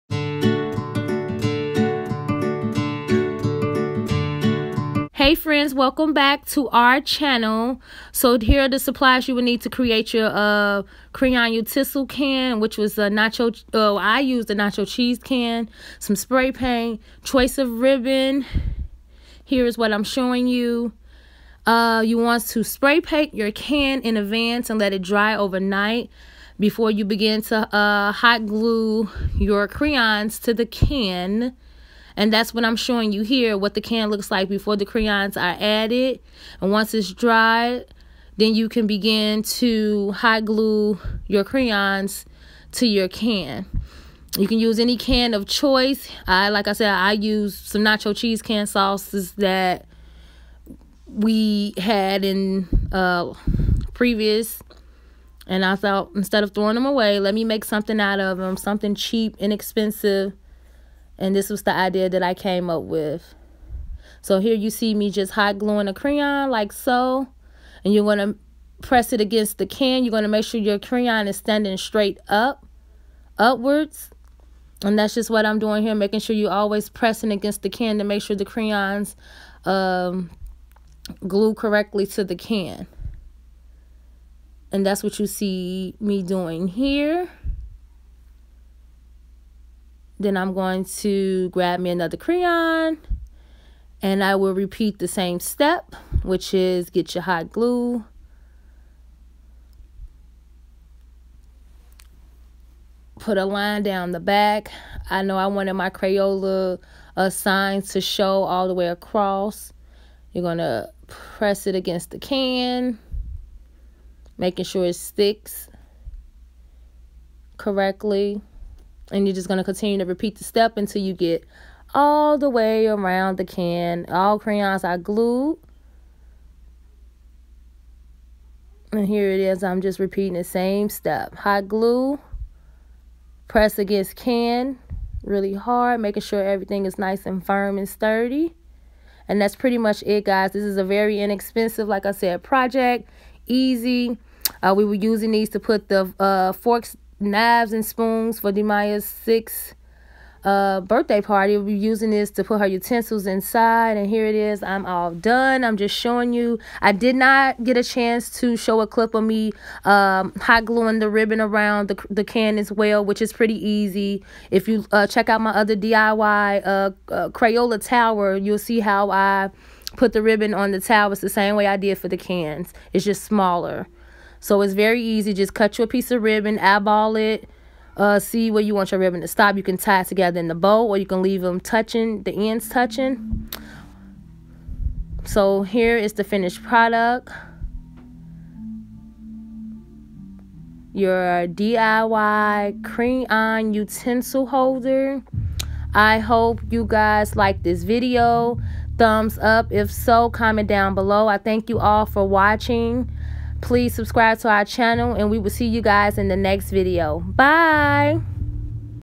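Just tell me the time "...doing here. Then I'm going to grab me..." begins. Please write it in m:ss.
1:26.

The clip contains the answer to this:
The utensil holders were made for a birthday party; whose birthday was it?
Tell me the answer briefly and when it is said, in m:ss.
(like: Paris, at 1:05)
De'Miya, at 2:28.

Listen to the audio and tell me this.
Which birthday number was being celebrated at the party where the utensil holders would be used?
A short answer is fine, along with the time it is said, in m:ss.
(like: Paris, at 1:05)
6th, at 2:29.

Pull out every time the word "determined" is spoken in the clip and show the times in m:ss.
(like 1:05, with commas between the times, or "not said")
not said.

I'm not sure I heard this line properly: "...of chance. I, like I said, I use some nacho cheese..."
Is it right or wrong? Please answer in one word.
wrong.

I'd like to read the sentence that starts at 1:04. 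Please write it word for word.
So here you see me just hot gluing a crayon like so.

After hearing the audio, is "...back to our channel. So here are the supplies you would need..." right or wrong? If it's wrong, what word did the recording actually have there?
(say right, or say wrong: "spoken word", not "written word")
right.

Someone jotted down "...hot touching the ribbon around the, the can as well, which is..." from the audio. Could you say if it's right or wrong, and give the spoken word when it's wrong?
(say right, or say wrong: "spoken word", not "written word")
wrong: "gluing", not "touching".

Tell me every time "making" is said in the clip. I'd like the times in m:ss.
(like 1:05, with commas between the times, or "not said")
1:15, 1:54, 2:15.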